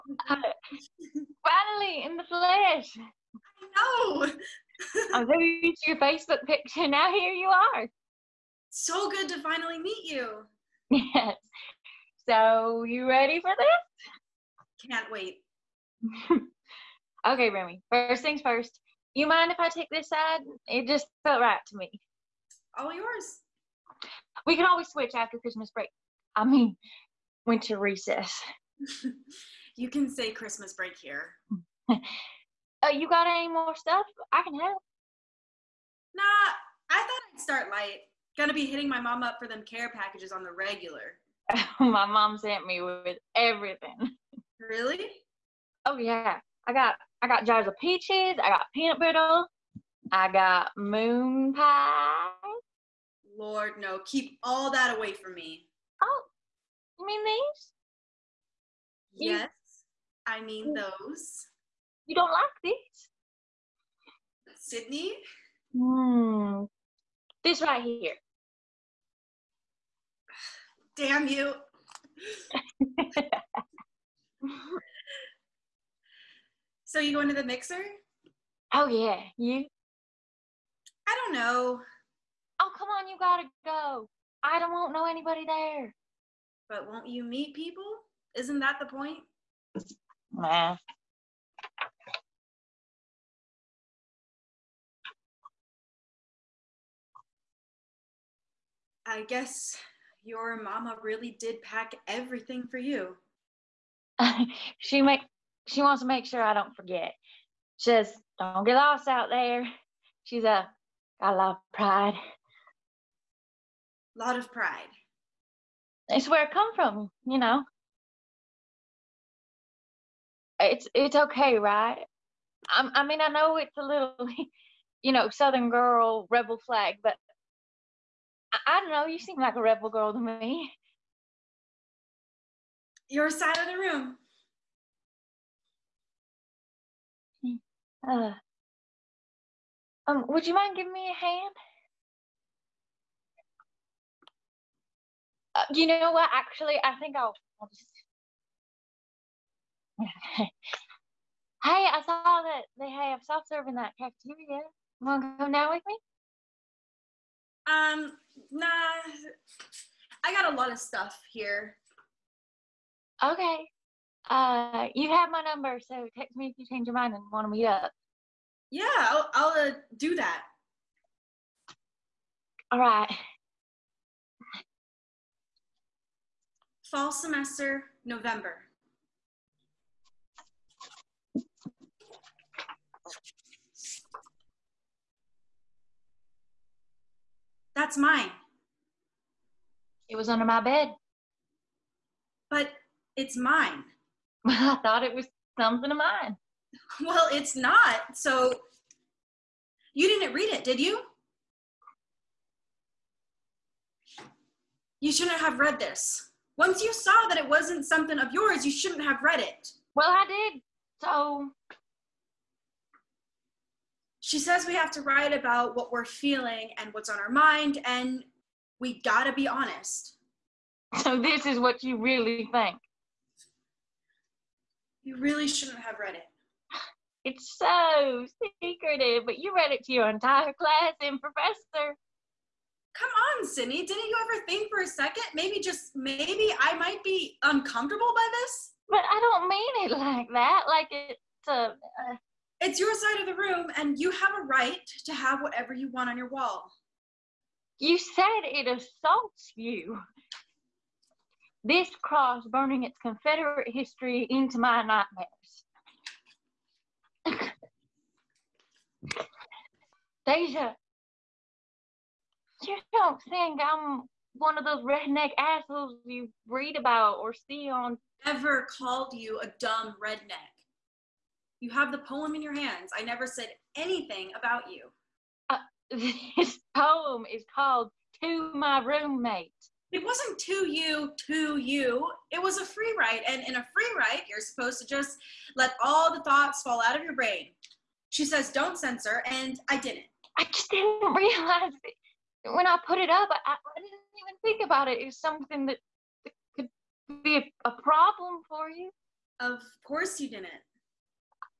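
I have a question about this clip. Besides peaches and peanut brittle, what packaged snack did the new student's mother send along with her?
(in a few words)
moon pie.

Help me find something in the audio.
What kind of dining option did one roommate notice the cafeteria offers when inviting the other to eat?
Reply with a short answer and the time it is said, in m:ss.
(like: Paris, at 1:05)
self serve, at 2:33.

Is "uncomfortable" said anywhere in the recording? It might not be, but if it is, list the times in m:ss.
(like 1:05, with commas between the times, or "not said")
3:57.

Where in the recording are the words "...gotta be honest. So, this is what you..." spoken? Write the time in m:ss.
3:39.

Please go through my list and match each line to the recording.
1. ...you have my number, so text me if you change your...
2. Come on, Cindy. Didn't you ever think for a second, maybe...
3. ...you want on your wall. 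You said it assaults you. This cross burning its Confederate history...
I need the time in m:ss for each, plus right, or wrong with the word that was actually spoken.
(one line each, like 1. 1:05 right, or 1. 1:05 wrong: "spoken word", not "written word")
1. 2:44 right
2. 3:52 right
3. 4:05 right.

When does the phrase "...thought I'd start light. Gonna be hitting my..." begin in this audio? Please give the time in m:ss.
0:36.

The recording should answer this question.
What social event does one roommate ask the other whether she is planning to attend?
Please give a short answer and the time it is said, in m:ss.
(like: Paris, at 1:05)
the mixer, at 1:17.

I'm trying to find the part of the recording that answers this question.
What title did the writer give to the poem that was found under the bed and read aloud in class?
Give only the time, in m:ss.
4:38.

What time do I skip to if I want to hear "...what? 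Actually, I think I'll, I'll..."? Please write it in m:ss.
2:26.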